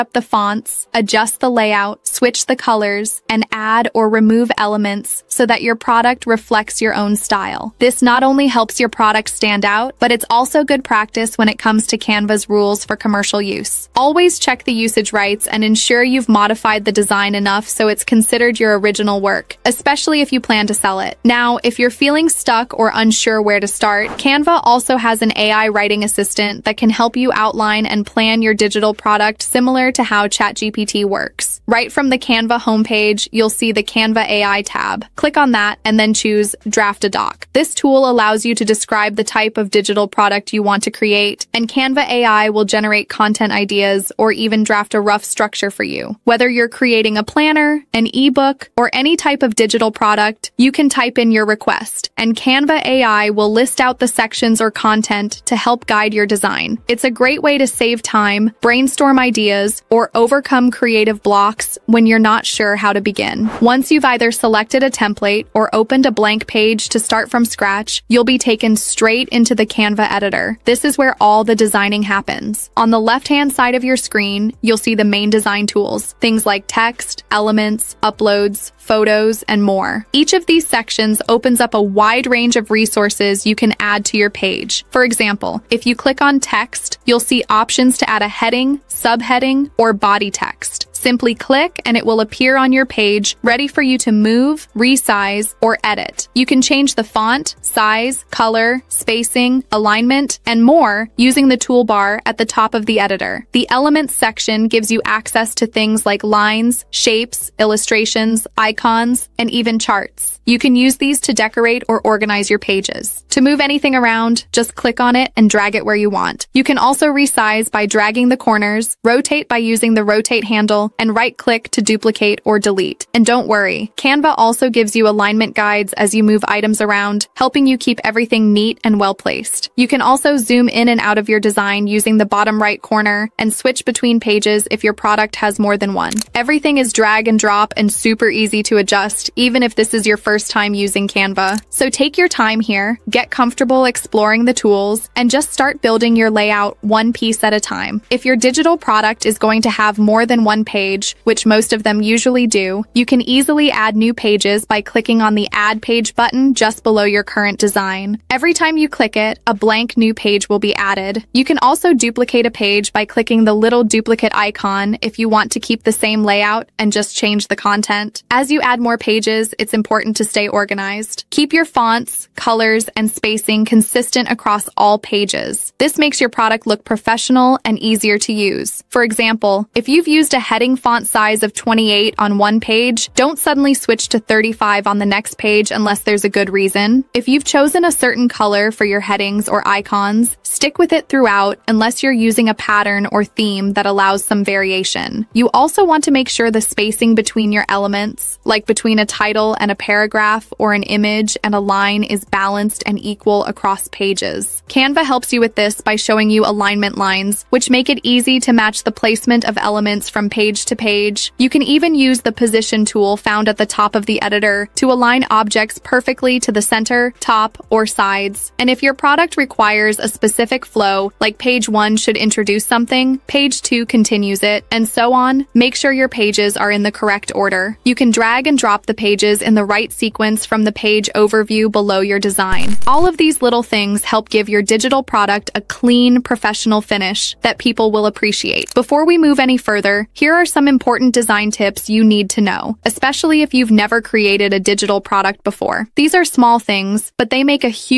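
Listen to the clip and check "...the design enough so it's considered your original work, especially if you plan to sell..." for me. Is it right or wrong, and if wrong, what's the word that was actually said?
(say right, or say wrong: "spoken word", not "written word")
right.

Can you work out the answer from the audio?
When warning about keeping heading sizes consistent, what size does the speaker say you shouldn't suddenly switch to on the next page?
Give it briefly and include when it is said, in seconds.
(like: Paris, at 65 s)
35, at 184 s.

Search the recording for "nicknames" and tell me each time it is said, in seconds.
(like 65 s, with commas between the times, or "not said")
not said.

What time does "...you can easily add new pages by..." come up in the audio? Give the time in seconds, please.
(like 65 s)
152 s.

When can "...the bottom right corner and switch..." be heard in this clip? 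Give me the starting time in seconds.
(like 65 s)
132 s.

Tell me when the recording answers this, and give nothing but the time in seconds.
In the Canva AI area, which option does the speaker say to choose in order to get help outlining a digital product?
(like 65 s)
36 s.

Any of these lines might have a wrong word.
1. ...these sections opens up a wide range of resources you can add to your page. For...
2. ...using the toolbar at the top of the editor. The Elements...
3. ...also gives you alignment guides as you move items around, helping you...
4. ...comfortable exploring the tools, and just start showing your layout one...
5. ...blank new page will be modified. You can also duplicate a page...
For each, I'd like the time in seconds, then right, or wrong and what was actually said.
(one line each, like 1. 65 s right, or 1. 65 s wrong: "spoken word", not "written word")
1. 80 s right
2. 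101 s right
3. 124 s right
4. 143 s wrong: "building", not "showing"
5. 159 s wrong: "added", not "modified".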